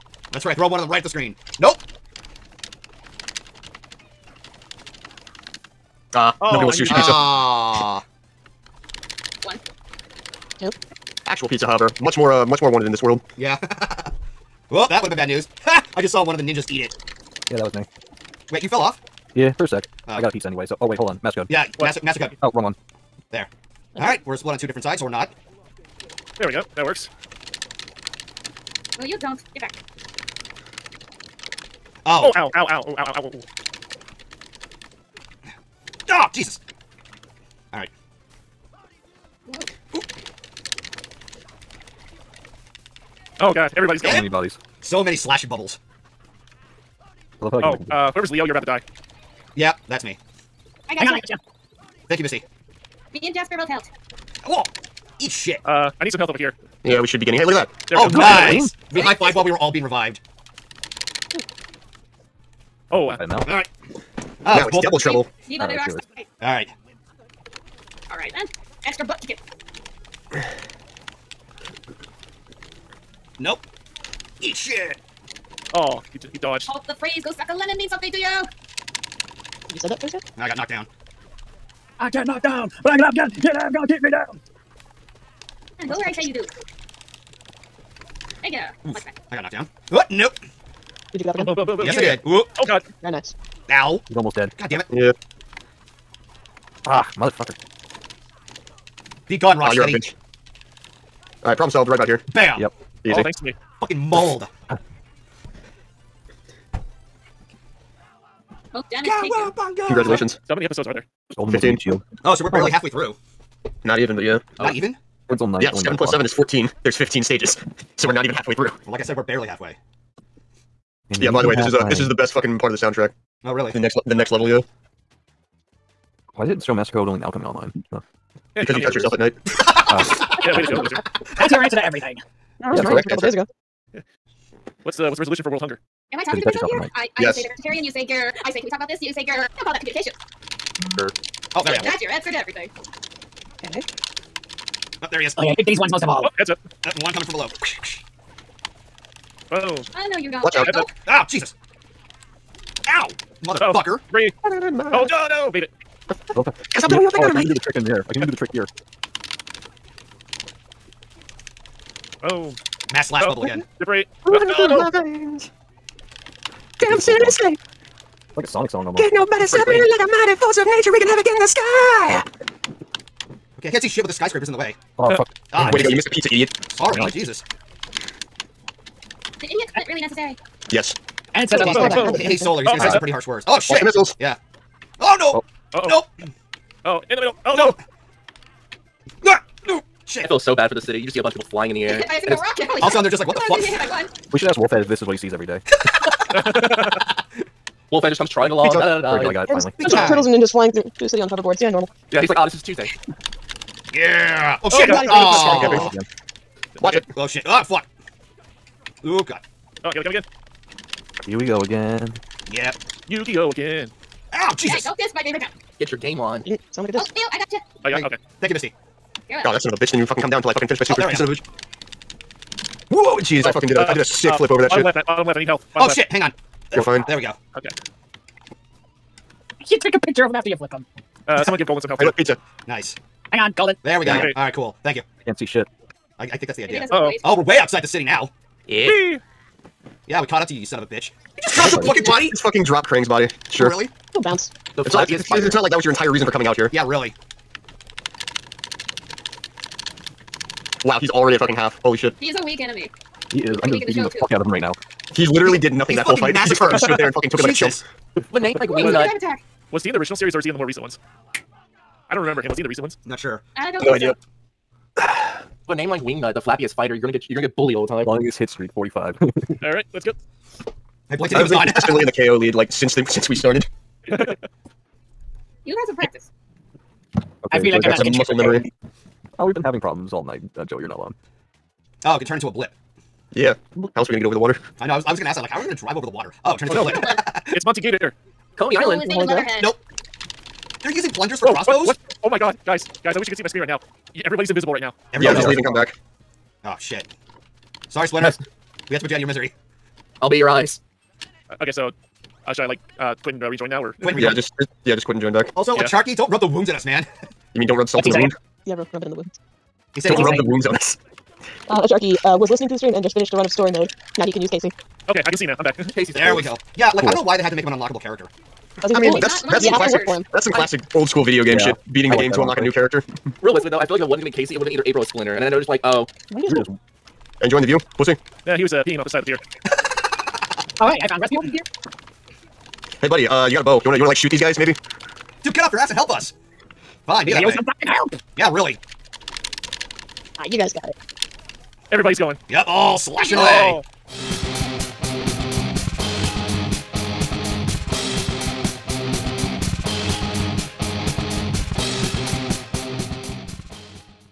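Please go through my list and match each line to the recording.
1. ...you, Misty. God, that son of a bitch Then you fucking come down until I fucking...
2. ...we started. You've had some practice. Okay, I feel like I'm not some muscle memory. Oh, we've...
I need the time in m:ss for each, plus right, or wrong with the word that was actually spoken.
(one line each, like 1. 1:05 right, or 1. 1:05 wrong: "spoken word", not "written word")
1. 3:38 right
2. 4:33 right.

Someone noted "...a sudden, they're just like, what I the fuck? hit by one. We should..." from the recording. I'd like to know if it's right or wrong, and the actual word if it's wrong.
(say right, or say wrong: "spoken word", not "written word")
right.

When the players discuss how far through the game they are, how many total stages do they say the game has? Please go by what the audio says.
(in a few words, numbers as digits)
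15.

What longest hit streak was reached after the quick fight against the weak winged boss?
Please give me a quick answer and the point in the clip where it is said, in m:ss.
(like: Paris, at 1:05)
45, at 4:28.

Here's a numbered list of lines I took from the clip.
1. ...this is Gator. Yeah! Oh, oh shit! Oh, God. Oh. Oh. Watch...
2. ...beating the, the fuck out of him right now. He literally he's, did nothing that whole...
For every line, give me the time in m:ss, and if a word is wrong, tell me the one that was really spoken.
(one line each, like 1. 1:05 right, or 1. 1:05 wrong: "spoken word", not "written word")
1. 3:22 wrong: "Tuesday", not "Gator"
2. 4:13 right.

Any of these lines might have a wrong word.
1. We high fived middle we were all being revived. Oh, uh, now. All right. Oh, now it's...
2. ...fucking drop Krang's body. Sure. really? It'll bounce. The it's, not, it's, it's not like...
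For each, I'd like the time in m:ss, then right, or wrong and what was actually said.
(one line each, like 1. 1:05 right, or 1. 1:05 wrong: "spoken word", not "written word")
1. 0:58 wrong: "while", not "middle"
2. 4:02 right.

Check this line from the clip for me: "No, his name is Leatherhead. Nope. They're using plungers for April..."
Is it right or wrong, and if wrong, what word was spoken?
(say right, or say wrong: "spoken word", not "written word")
wrong: "Whoa", not "April".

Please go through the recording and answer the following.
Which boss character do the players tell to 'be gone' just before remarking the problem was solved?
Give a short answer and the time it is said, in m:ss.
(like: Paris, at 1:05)
Rocksteady, at 1:39.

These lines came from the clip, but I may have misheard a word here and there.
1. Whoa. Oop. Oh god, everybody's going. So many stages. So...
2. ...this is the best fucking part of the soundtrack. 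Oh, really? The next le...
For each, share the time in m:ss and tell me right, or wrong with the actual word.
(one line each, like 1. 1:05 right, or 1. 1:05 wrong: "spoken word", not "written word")
1. 0:39 wrong: "bodies", not "stages"
2. 2:01 right.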